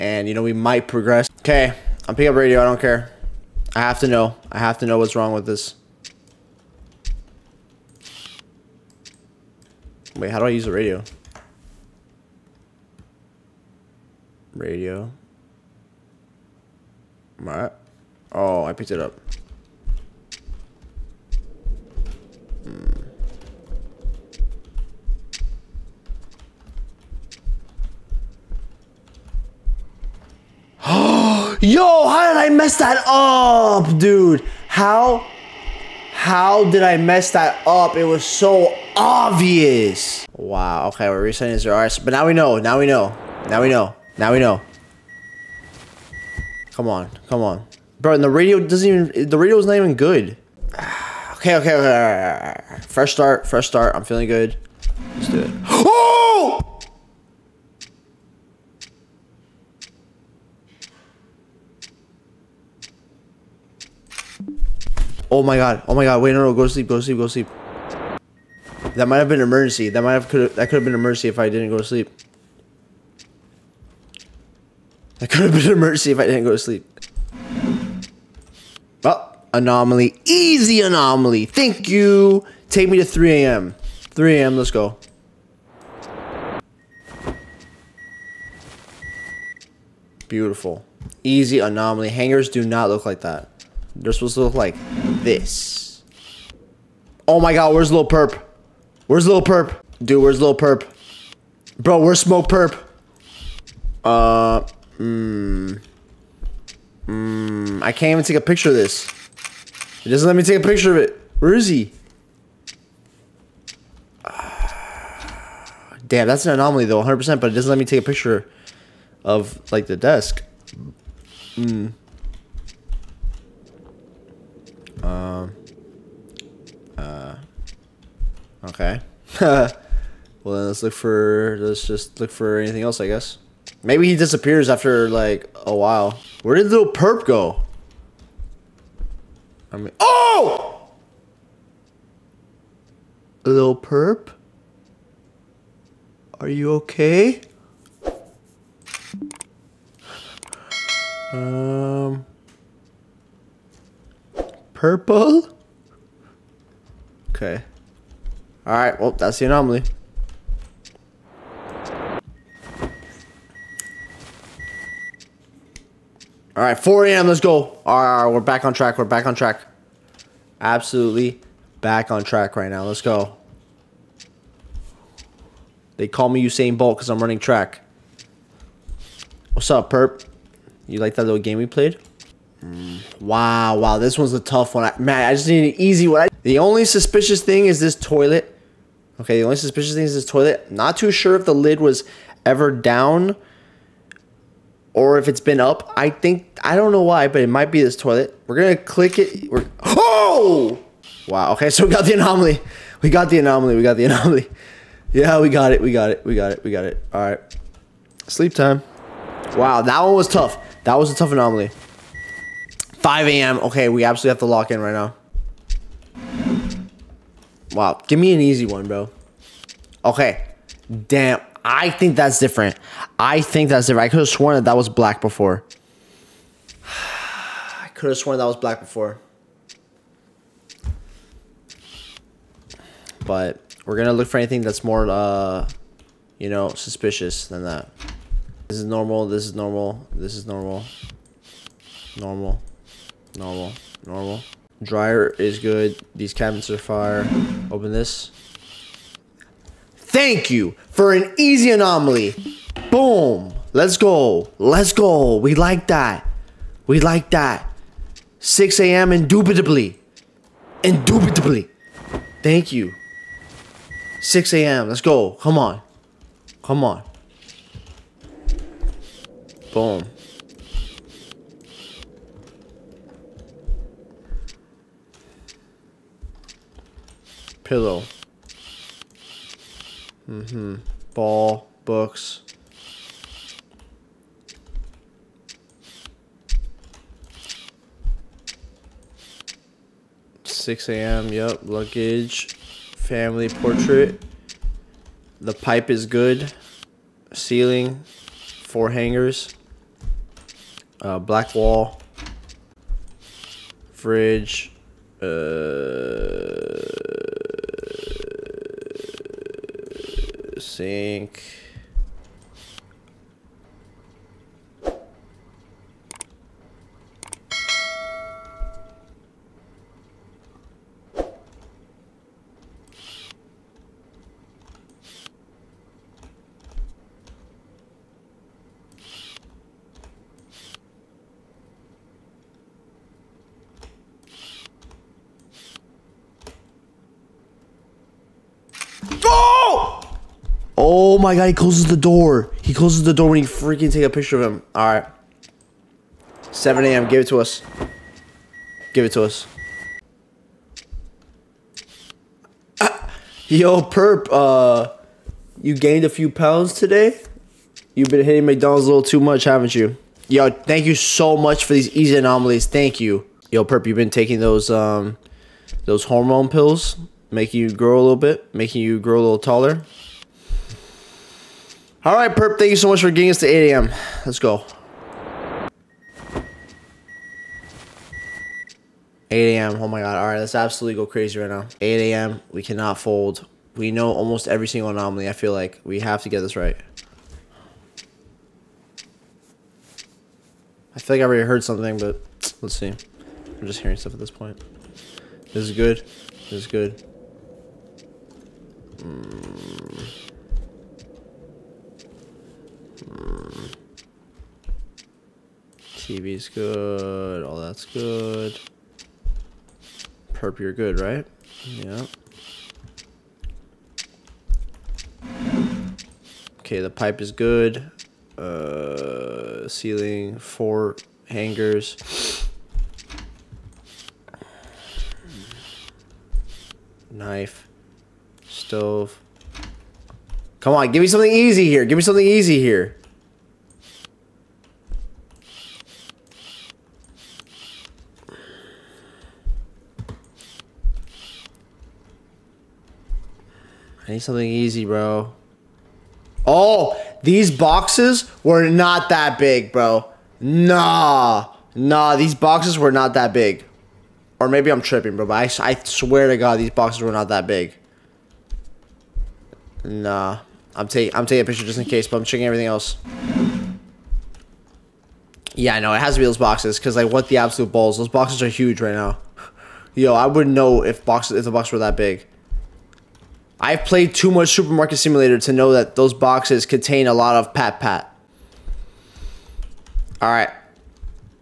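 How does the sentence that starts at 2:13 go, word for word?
Maybe he disappears after like a while.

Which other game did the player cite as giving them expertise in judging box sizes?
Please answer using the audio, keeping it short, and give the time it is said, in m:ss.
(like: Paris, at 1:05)
Supermarket Simulator, at 7:54.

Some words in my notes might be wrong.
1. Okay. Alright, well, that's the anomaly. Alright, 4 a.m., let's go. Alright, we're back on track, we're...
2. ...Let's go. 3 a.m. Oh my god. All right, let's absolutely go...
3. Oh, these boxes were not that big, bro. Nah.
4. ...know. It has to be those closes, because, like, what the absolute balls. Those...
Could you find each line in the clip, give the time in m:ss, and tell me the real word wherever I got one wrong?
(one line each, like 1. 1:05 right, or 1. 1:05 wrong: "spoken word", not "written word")
1. 2:37 right
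2. 6:14 wrong: "8", not "3"
3. 7:26 right
4. 7:45 wrong: "boxes", not "closes".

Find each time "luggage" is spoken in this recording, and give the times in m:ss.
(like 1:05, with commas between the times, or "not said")
4:51.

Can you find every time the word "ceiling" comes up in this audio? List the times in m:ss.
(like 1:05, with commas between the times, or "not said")
4:57, 6:59.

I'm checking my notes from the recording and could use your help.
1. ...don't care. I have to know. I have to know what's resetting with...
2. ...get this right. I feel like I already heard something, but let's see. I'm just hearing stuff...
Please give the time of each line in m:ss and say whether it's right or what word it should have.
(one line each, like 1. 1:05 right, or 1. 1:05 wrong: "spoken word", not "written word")
1. 0:02 wrong: "wrong", not "resetting"
2. 6:26 right.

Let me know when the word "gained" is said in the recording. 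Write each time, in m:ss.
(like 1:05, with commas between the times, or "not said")
5:55.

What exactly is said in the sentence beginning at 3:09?
Okay, the only suspicious thing is this toilet.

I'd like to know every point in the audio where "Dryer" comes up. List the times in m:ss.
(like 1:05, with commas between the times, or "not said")
4:04.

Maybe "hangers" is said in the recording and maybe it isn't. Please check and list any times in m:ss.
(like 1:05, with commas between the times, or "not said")
1:32, 4:58, 7:01.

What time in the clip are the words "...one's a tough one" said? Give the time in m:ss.
3:04.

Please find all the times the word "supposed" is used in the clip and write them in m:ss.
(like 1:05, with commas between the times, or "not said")
1:34.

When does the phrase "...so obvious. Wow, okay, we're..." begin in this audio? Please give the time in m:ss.
0:38.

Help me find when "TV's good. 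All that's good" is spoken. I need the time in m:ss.
6:46.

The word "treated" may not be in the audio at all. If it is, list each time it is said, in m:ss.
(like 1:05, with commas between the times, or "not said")
not said.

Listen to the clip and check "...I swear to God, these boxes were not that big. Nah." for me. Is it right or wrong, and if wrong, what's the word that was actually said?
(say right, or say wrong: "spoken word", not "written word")
right.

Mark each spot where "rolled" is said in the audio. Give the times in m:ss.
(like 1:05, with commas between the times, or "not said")
not said.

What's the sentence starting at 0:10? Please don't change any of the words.
Wait, how do I use the radio?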